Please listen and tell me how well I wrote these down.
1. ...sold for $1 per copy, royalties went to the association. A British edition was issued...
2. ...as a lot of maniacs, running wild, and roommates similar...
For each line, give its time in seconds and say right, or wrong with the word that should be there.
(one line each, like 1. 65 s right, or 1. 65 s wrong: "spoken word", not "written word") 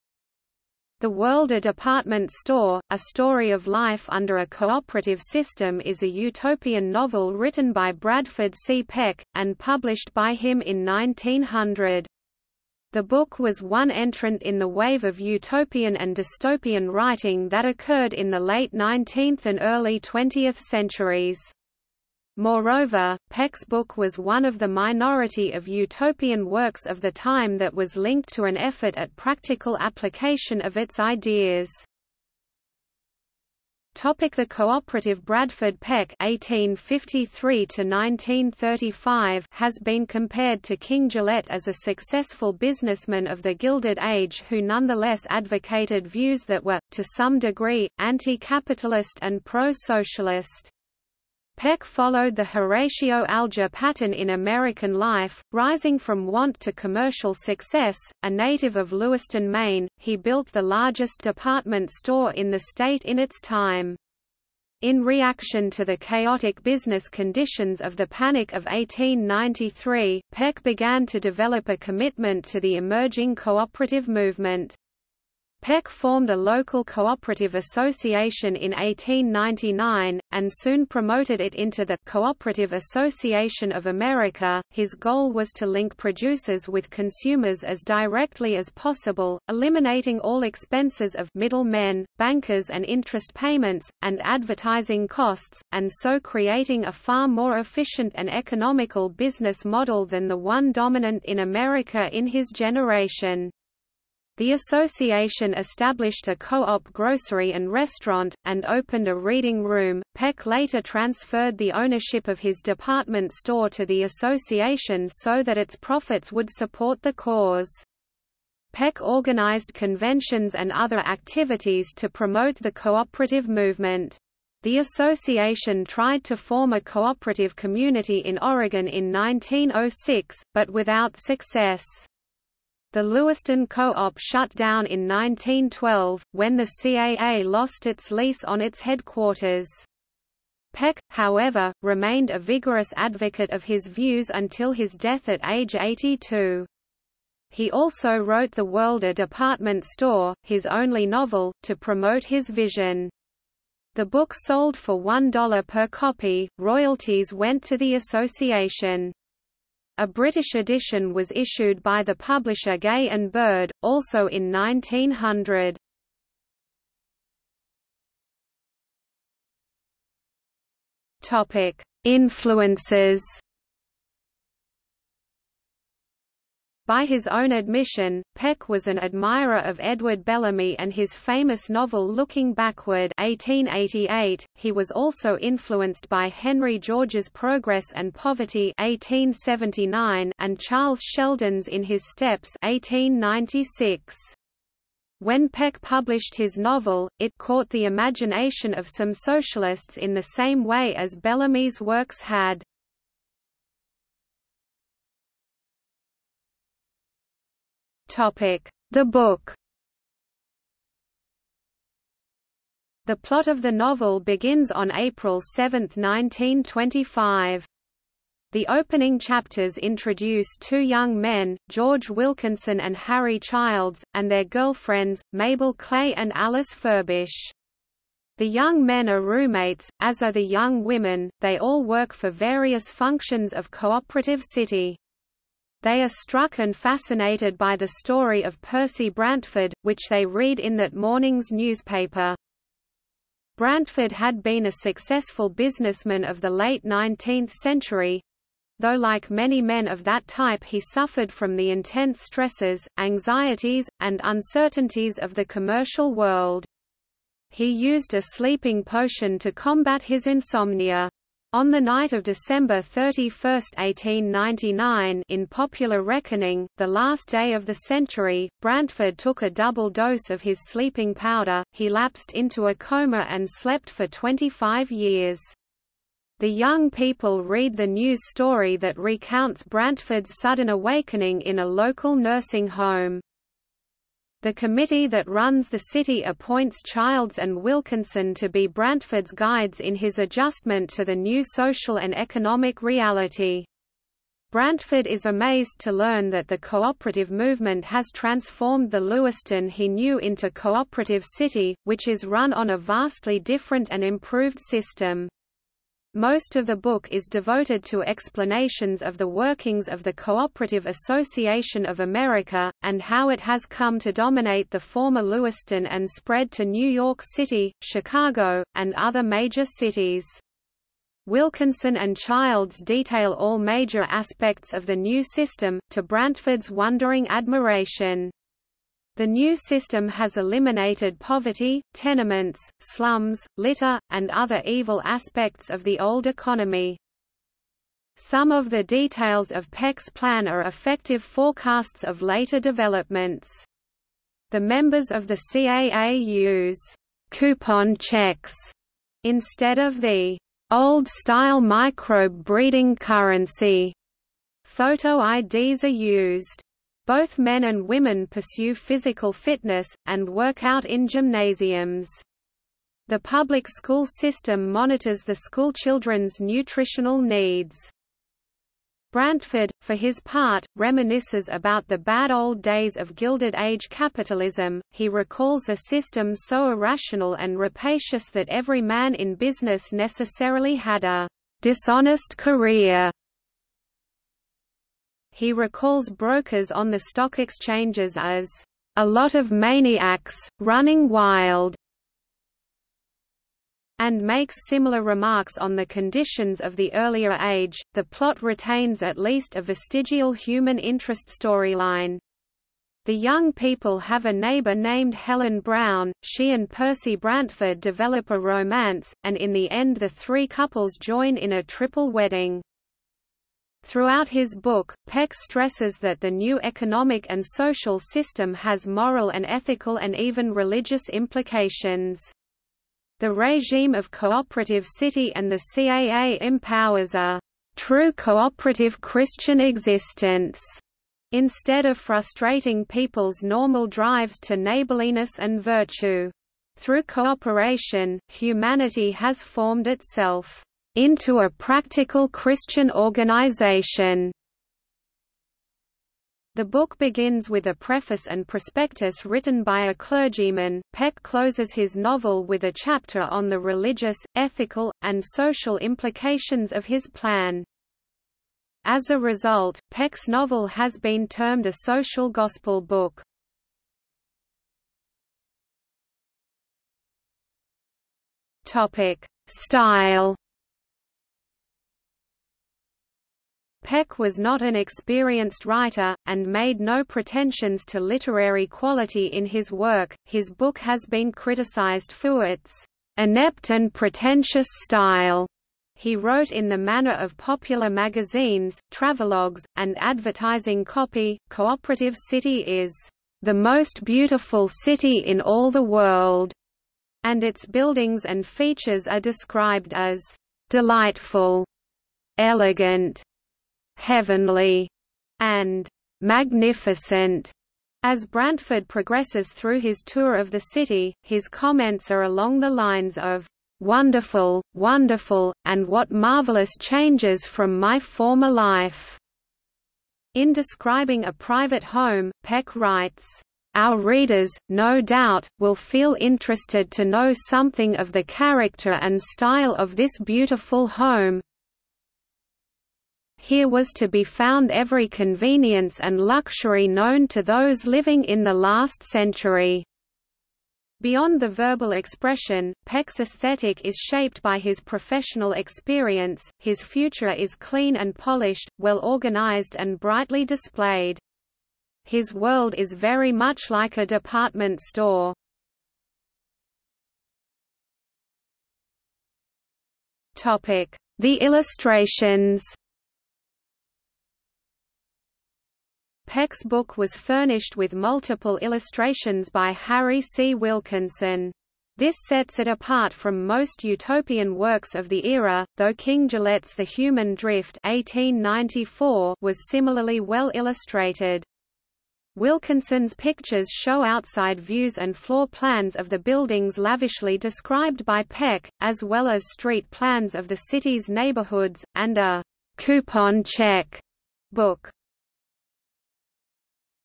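1. 154 s right
2. 388 s wrong: "makes", not "roommates".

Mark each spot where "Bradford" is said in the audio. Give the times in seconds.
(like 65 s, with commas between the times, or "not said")
7 s, 35 s.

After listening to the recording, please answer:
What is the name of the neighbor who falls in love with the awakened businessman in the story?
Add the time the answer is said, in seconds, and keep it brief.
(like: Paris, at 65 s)
Helen Brown, at 405 s.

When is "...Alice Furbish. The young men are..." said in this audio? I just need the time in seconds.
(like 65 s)
226 s.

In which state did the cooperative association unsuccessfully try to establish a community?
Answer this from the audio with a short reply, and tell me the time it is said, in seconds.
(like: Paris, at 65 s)
Oregon, at 128 s.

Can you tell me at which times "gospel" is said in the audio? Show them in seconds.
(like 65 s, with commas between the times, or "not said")
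462 s.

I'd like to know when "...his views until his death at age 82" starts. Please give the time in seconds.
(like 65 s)
143 s.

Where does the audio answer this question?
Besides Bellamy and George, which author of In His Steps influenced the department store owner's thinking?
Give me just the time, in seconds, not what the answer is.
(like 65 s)
190 s.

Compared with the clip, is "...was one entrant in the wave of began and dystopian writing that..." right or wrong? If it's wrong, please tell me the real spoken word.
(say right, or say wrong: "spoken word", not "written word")
wrong: "utopian", not "began".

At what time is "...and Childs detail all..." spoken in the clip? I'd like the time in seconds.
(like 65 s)
321 s.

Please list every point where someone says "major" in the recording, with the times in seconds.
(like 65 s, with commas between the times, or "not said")
319 s, 323 s.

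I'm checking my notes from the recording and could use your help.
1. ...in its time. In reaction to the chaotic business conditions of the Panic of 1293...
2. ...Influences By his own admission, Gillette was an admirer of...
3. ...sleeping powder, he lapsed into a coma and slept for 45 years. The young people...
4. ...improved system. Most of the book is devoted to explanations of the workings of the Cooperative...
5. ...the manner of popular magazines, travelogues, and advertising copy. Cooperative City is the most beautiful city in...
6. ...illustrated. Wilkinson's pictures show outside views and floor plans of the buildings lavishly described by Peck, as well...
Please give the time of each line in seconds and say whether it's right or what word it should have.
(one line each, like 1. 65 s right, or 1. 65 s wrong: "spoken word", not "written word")
1. 63 s wrong: "1893", not "1293"
2. 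172 s wrong: "Peck", not "Gillette"
3. 270 s wrong: "25", not "45"
4. 304 s right
5. 486 s right
6. 580 s right.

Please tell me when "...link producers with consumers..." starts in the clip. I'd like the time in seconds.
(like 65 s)
85 s.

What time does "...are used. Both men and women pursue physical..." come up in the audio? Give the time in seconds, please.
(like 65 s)
355 s.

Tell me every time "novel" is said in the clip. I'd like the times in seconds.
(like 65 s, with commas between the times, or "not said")
6 s, 151 s, 181 s, 196 s, 213 s, 451 s, 460 s.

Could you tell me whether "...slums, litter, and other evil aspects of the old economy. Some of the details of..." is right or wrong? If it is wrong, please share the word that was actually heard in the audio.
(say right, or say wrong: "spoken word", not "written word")
right.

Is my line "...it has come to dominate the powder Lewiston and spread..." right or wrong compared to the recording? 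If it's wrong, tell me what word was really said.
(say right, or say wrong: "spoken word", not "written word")
wrong: "former", not "powder".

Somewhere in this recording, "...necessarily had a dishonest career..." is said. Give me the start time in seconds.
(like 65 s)
379 s.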